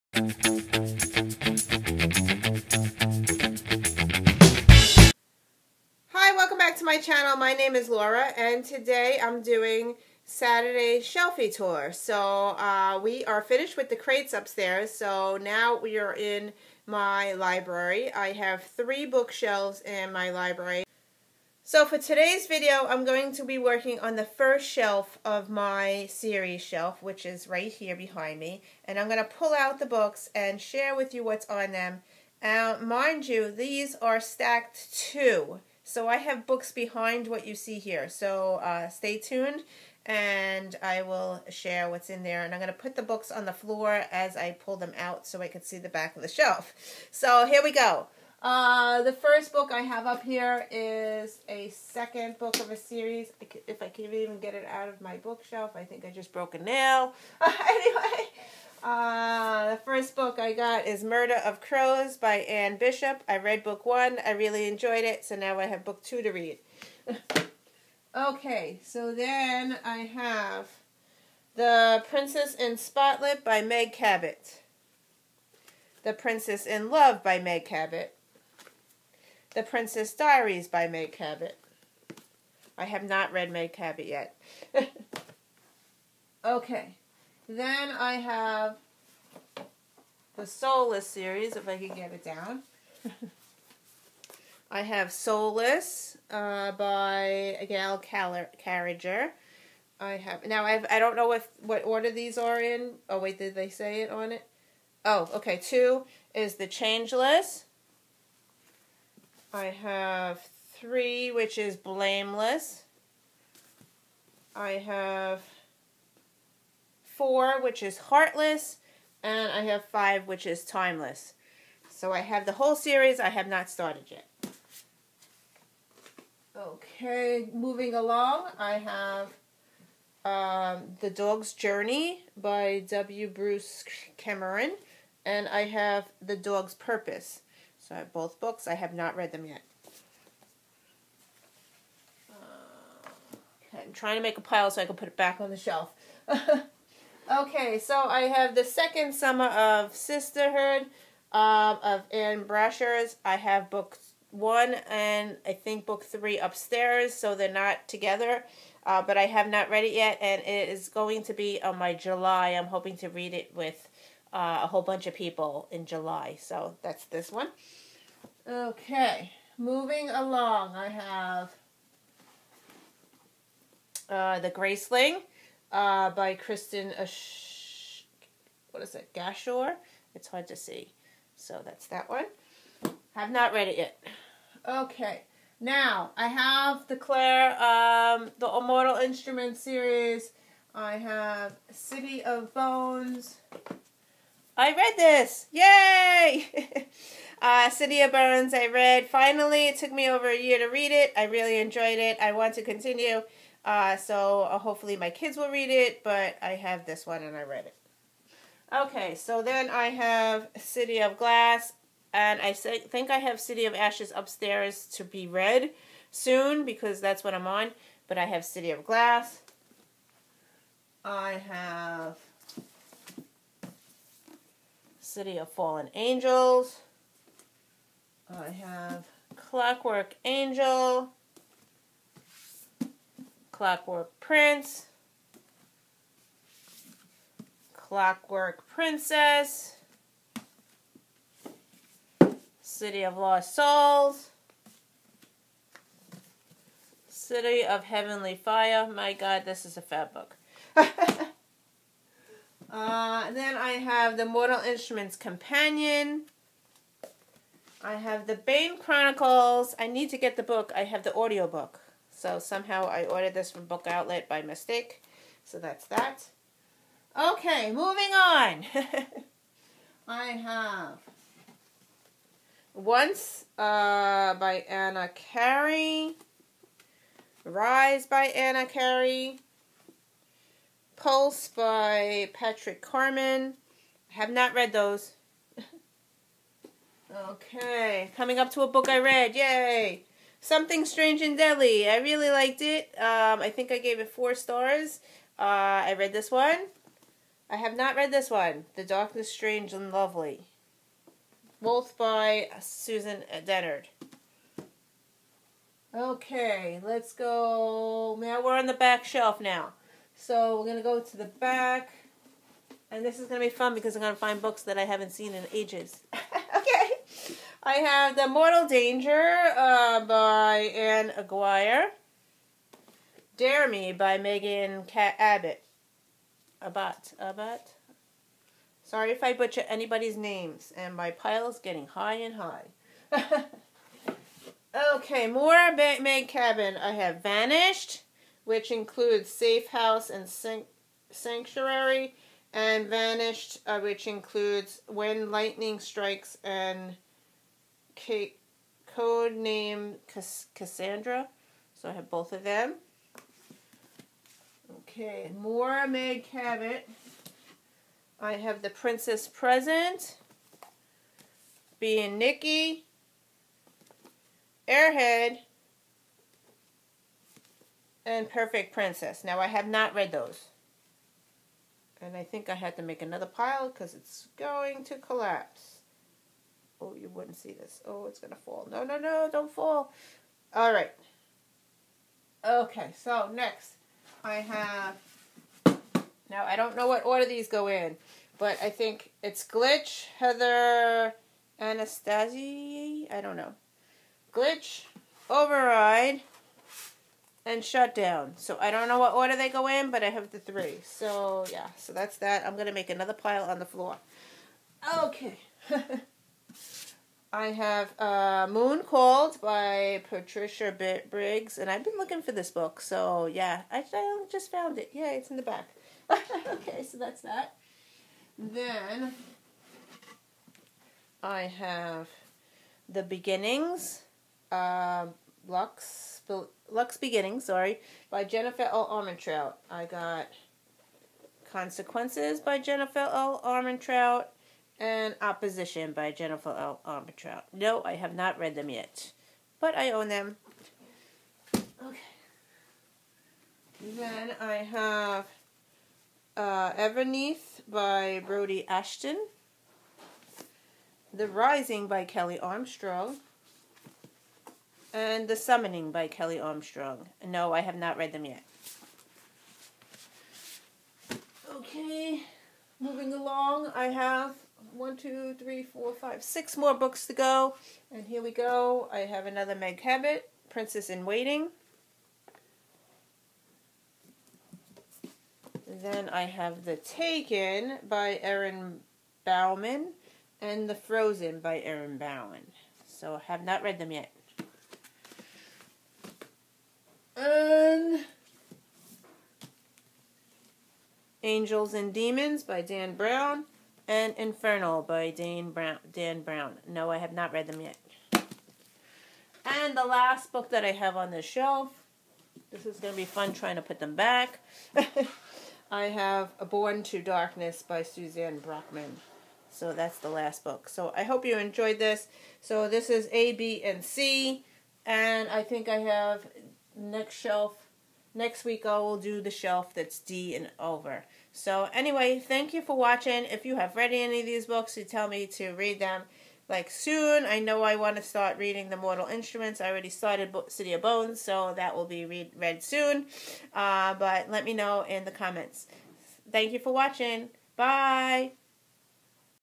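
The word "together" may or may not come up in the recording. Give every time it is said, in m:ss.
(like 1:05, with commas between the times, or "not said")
2:37.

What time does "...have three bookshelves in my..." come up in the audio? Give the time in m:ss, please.
0:18.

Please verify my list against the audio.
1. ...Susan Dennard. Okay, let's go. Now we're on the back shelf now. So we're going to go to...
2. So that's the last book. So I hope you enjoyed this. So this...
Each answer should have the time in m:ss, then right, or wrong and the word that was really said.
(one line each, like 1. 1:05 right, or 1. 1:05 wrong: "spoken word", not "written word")
1. 5:02 right
2. 8:29 right.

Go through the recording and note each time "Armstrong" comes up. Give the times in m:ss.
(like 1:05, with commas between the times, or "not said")
7:32, 7:36.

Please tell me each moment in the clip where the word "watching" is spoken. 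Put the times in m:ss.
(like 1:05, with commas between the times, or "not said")
8:42, 8:56.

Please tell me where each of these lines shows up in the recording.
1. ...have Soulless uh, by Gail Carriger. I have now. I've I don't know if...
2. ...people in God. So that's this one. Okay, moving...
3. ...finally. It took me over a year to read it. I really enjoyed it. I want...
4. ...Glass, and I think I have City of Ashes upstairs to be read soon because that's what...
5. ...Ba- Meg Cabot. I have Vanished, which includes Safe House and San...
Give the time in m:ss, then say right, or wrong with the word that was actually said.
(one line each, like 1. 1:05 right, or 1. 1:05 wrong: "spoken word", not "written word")
1. 1:34 right
2. 2:45 wrong: "July", not "God"
3. 3:19 right
4. 3:31 right
5. 5:35 right.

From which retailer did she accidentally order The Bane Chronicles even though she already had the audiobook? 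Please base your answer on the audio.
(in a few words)
Book Outlet.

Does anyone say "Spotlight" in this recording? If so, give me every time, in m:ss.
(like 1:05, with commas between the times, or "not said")
1:12.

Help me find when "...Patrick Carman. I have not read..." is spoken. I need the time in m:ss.
4:42.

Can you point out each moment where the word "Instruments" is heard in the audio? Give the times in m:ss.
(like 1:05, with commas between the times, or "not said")
3:08, 4:14, 8:49.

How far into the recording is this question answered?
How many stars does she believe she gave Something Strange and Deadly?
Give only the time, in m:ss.
4:54.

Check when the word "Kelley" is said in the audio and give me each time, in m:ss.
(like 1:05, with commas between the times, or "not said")
7:32, 7:36.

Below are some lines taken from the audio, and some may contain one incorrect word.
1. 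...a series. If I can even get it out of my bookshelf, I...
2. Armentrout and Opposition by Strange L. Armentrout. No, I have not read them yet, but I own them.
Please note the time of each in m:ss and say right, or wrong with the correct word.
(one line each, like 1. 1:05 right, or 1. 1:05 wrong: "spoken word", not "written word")
1. 0:52 right
2. 7:13 wrong: "Jennifer", not "Strange".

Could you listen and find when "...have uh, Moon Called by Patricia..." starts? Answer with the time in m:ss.
6:47.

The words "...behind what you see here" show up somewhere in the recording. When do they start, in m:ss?
0:36.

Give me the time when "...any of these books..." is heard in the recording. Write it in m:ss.
8:43.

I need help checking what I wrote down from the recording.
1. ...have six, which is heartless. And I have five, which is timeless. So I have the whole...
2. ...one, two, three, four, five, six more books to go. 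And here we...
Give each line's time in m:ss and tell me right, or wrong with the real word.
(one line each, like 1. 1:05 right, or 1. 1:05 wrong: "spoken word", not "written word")
1. 1:54 wrong: "four", not "six"
2. 7:44 right.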